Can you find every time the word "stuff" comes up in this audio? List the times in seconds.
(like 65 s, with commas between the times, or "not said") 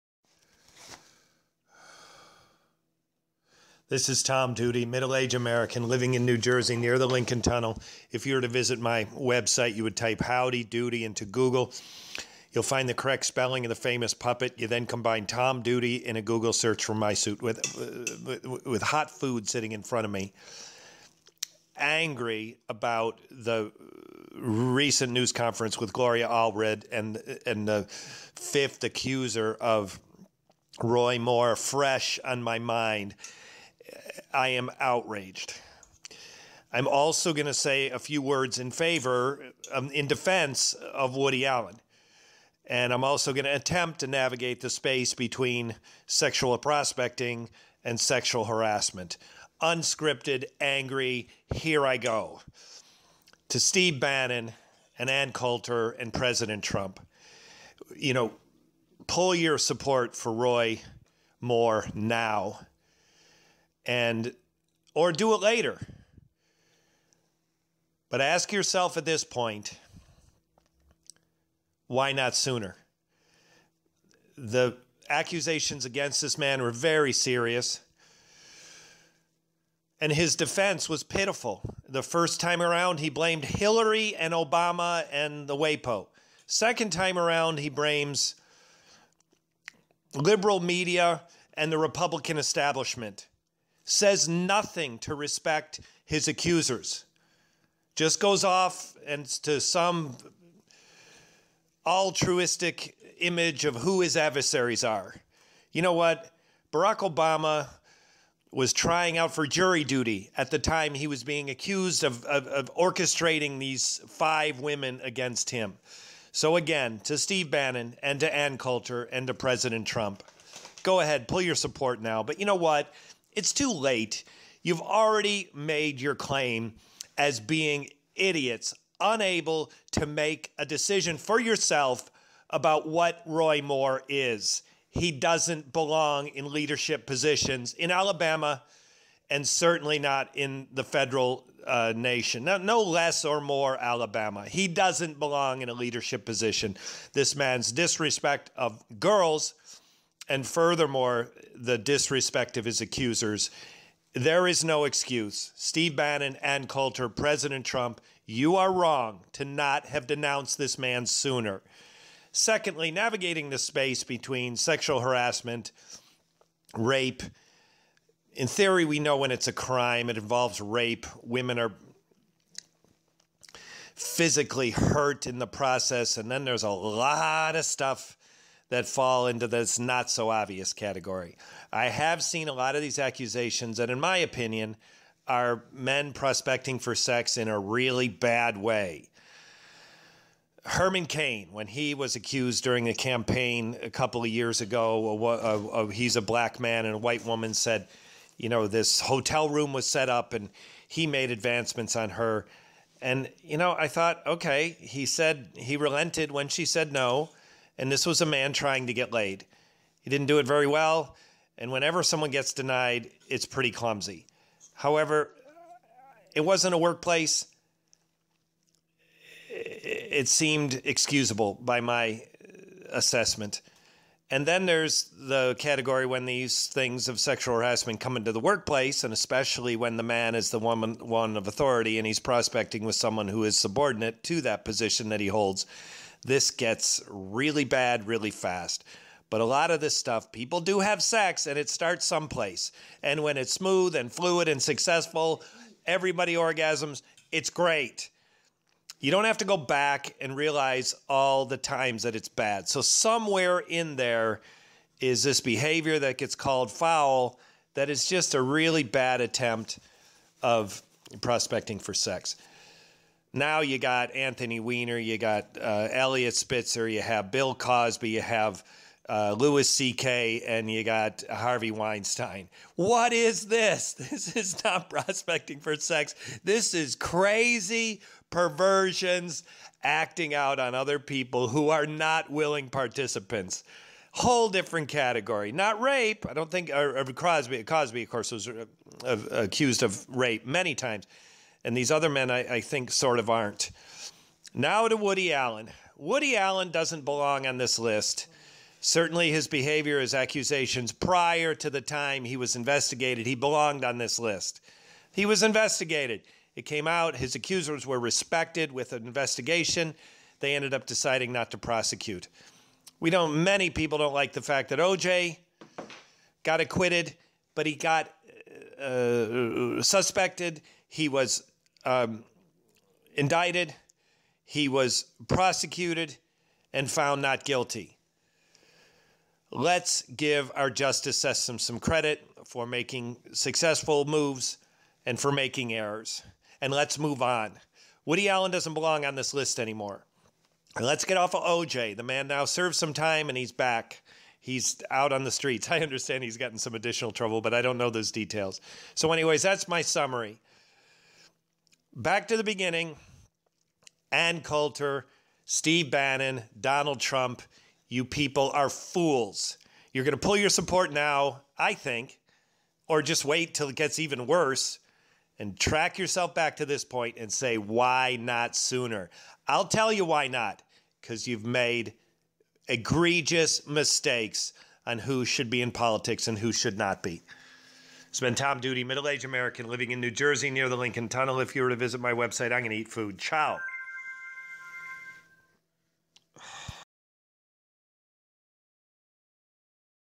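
177 s, 239 s.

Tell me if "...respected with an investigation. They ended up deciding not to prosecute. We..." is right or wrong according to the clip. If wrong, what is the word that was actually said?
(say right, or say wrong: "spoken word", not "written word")
right.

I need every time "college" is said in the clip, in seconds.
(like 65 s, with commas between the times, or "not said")
not said.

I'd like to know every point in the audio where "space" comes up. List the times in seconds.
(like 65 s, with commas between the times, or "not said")
44 s, 163 s.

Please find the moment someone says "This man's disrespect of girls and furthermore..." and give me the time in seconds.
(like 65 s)
147 s.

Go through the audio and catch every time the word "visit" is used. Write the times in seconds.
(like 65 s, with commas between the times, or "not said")
8 s, 381 s.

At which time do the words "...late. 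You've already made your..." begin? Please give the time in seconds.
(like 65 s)
123 s.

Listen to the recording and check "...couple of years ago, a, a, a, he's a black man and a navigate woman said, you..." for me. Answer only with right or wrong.
wrong.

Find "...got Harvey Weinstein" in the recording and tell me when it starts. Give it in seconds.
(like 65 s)
270 s.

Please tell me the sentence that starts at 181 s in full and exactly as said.
I have seen a lot of these accusations that, in my opinion, are men prospecting for sex in a really bad way.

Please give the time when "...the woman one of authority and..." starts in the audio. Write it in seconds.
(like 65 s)
230 s.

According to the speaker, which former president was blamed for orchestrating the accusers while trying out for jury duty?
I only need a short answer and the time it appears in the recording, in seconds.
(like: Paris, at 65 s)
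Barack Obama, at 106 s.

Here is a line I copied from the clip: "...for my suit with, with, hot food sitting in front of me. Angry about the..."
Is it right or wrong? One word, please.
right.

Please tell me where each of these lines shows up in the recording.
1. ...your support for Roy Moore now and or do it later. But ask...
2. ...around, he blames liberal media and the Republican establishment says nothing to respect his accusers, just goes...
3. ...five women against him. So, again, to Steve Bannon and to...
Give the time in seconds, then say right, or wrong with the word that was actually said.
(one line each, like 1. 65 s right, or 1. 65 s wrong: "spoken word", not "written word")
1. 59 s right
2. 87 s right
3. 114 s right.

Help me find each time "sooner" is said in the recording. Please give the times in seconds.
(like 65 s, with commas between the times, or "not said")
72 s, 161 s, 368 s.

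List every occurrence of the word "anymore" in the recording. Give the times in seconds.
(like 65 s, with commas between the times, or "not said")
339 s.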